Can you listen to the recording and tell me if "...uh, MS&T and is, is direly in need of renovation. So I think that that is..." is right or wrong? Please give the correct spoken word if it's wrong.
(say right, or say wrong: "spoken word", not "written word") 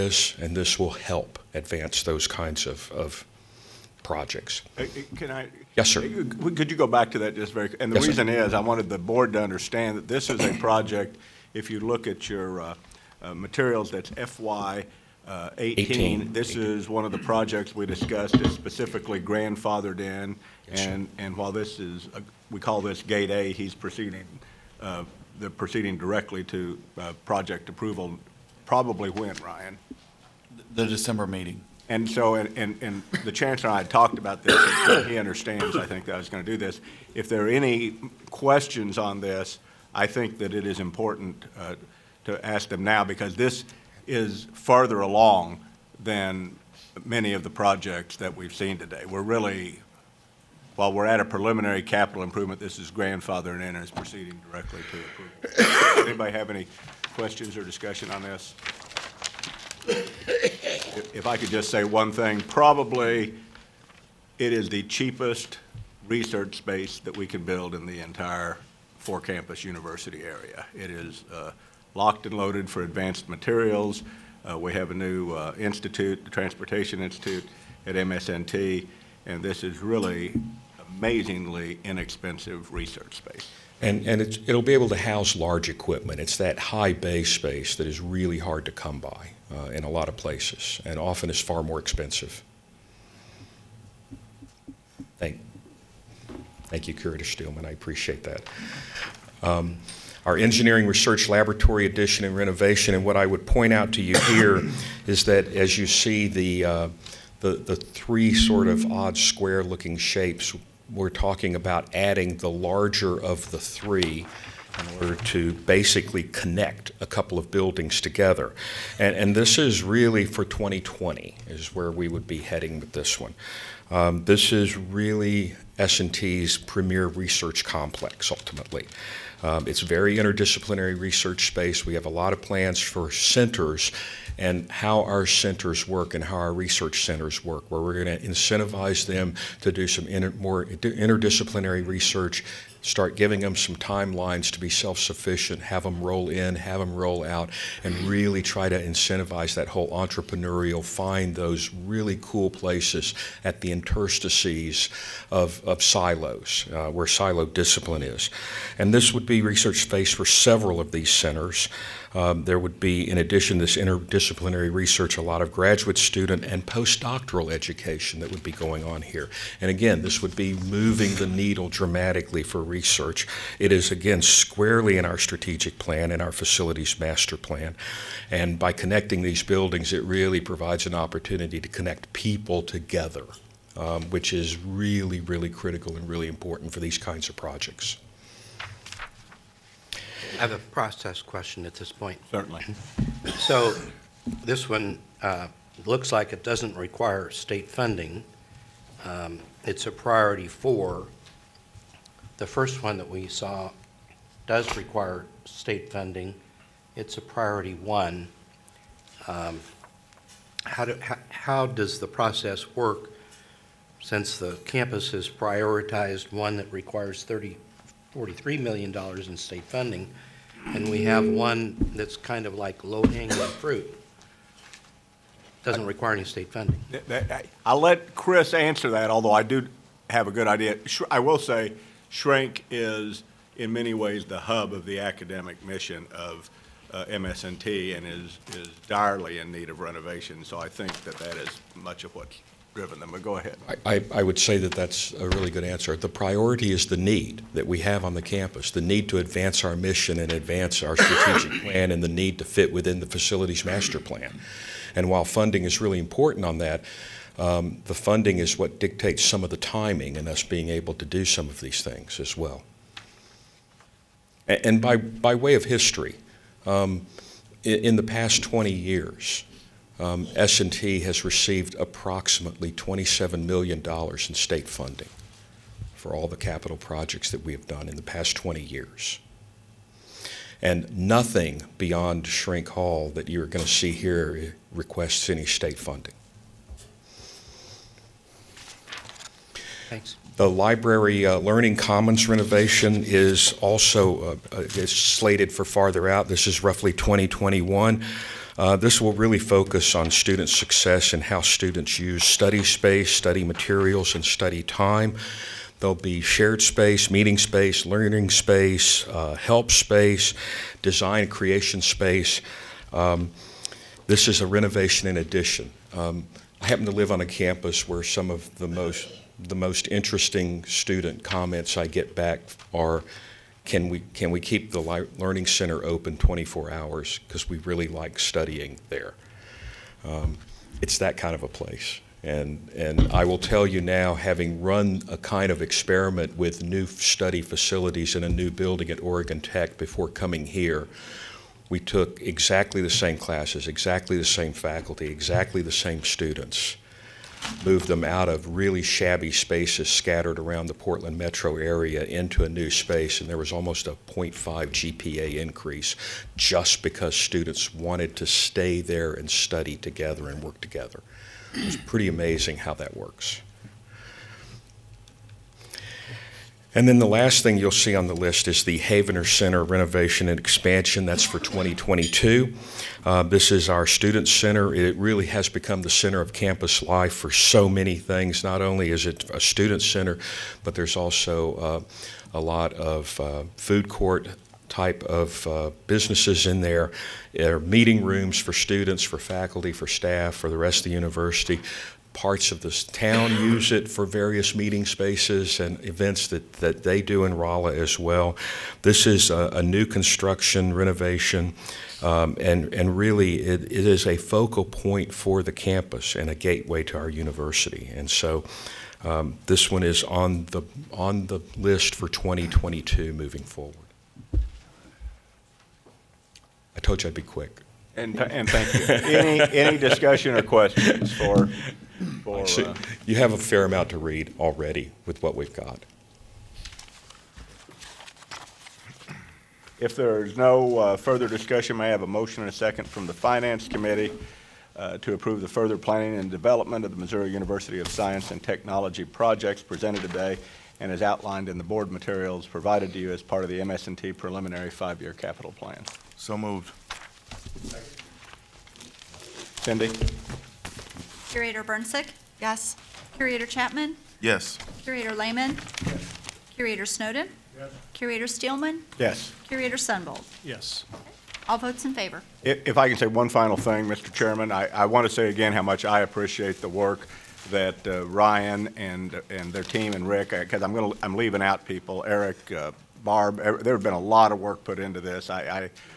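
right.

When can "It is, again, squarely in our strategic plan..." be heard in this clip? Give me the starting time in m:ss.
2:53.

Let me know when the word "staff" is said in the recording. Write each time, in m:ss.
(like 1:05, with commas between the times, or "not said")
6:29.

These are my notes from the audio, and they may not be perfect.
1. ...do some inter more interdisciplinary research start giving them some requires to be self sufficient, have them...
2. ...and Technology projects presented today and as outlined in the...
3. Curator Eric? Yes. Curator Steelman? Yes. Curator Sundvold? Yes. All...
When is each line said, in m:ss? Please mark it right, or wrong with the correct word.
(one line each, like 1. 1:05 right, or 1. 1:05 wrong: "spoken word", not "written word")
1. 2:19 wrong: "timelines", not "requires"
2. 7:18 right
3. 7:36 wrong: "Snowden", not "Eric".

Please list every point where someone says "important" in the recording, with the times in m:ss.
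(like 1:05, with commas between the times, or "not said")
0:40, 3:06, 4:15.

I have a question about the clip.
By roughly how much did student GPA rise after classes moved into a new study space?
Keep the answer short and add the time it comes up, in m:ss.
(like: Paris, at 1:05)
0.5, at 5:54.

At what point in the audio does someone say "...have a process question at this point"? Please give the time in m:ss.
3:10.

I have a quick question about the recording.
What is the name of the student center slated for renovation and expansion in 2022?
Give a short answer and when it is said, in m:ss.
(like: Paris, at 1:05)
Havener Center, at 6:08.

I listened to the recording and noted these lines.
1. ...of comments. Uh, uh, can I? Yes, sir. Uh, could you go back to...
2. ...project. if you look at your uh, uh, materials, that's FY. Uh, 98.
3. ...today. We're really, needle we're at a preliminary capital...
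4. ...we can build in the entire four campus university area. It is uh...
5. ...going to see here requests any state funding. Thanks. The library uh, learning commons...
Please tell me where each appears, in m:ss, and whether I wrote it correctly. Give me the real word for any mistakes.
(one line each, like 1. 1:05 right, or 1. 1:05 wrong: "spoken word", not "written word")
1. 0:02 wrong: "projects", not "comments"
2. 0:10 wrong: "18", not "98"
3. 0:48 wrong: "while", not "needle"
4. 1:07 right
5. 4:43 right.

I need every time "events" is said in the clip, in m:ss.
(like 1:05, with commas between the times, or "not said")
6:35.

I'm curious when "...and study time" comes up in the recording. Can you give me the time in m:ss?
5:04.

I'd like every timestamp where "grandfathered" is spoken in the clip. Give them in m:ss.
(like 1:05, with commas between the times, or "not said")
0:19, 0:52.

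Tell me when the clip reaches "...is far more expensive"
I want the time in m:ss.
1:31.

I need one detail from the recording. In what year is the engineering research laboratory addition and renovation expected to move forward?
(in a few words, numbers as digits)
2020.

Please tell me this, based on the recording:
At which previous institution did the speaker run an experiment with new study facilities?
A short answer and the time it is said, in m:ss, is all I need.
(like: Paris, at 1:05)
Oregon Tech, at 5:38.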